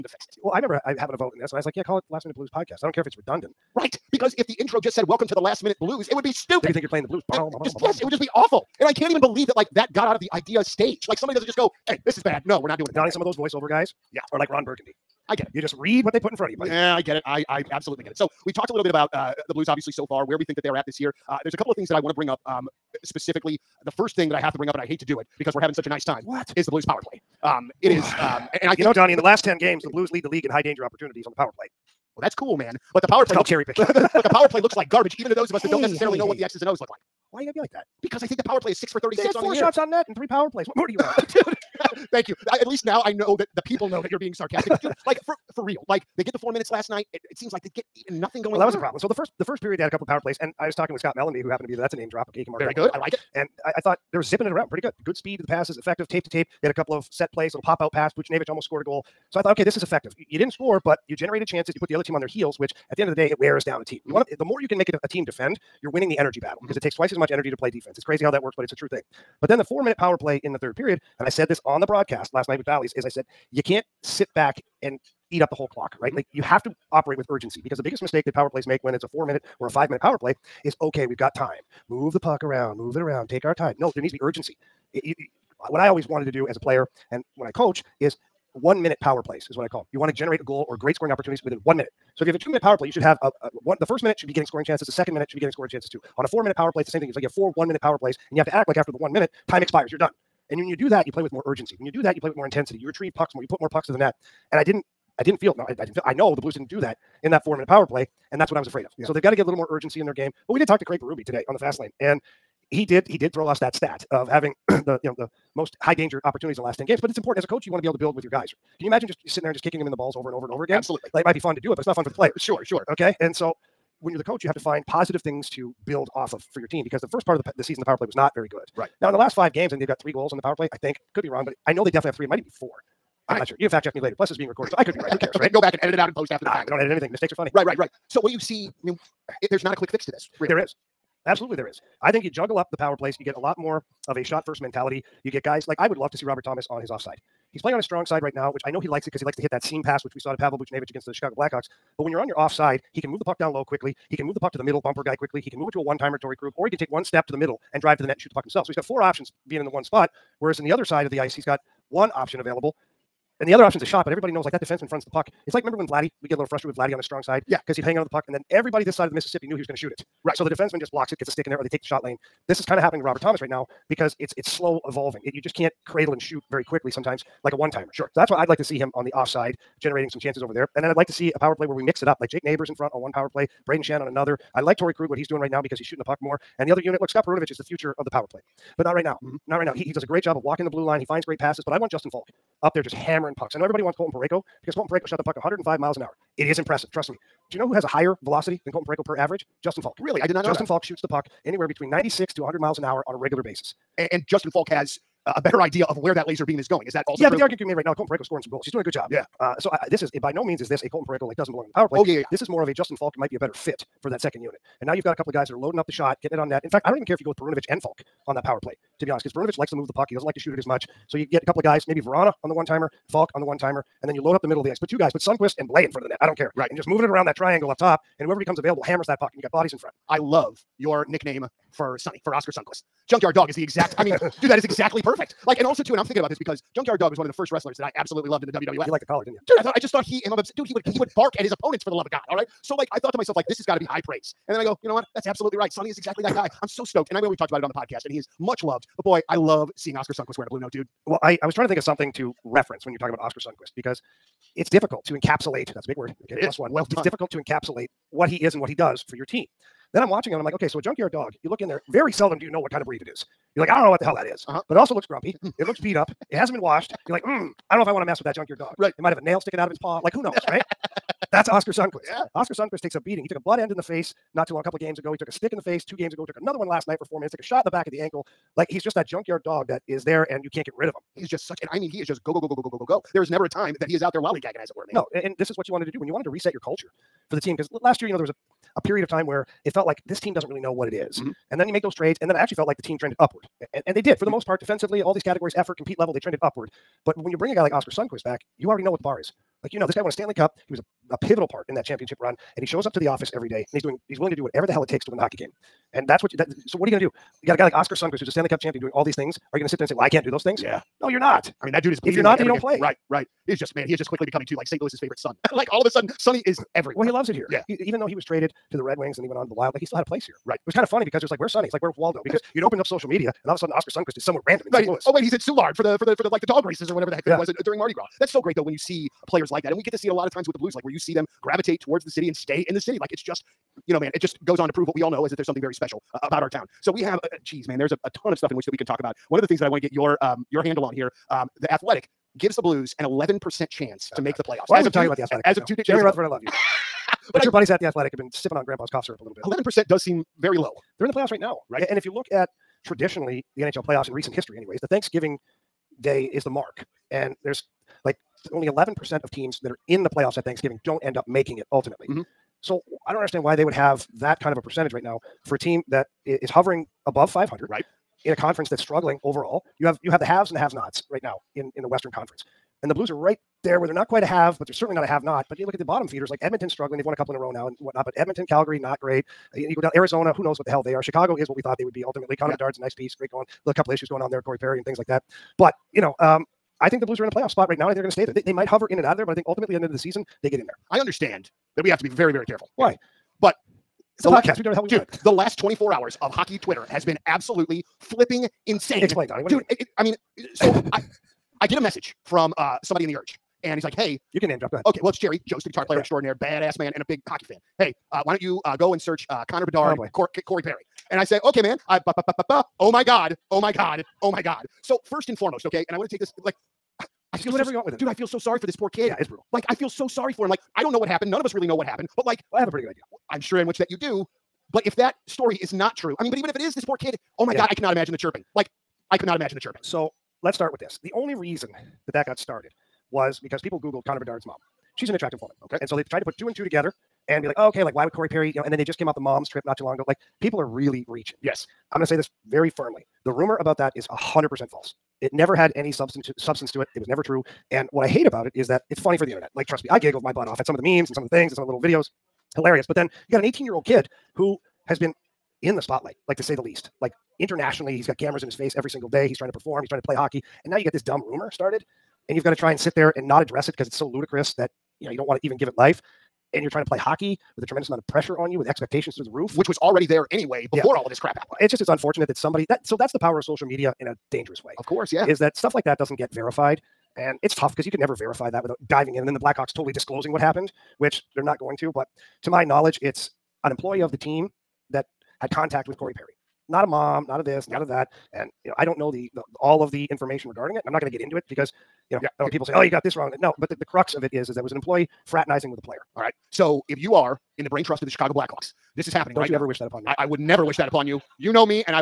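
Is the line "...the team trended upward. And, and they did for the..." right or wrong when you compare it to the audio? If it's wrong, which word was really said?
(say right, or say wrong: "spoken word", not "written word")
right.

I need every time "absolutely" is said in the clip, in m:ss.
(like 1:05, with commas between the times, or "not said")
0:17, 2:00, 2:21, 3:57, 4:05, 6:37.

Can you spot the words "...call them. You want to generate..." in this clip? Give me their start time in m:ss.
1:29.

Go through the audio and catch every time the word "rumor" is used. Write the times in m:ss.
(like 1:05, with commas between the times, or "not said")
7:23, 7:41.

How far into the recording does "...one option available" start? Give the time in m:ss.
2:41.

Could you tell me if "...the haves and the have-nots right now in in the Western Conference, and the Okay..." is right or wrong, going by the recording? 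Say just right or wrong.
wrong.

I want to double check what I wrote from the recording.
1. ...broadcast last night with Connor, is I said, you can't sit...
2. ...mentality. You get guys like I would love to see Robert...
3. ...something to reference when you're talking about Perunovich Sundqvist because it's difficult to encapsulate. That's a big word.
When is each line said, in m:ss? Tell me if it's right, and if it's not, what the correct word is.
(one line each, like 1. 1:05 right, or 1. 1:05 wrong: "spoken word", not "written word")
1. 1:11 wrong: "Valleys", not "Connor"
2. 2:24 right
3. 4:11 wrong: "Oscar", not "Perunovich".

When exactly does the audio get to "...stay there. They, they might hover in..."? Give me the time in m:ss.
6:28.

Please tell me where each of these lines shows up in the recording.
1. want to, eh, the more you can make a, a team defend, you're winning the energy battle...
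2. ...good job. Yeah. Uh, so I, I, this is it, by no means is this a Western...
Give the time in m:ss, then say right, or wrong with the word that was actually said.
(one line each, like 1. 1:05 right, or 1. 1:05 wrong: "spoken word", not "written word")
1. 1:04 right
2. 3:28 wrong: "Colton", not "Western".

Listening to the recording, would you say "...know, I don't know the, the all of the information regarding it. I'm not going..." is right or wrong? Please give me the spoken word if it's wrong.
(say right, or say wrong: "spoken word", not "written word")
right.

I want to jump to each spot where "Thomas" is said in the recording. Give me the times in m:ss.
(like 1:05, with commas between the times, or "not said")
2:26, 2:53.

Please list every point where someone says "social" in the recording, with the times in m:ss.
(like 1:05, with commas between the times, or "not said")
5:22, 7:53.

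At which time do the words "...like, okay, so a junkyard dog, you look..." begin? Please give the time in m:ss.
4:20.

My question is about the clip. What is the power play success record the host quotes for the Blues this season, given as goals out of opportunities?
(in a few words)
6 for 36.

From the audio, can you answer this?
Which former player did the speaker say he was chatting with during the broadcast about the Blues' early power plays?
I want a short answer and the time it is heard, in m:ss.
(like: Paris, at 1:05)
Scott Mellanby, at 0:50.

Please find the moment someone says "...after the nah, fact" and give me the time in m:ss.
2:16.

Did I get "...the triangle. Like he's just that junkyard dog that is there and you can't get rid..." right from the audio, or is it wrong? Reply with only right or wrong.
wrong.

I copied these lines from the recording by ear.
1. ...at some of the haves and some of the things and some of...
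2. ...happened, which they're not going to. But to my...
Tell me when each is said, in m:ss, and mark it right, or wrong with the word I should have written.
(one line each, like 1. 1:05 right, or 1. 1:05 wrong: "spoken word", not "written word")
1. 7:30 wrong: "memes", not "haves"
2. 8:00 right.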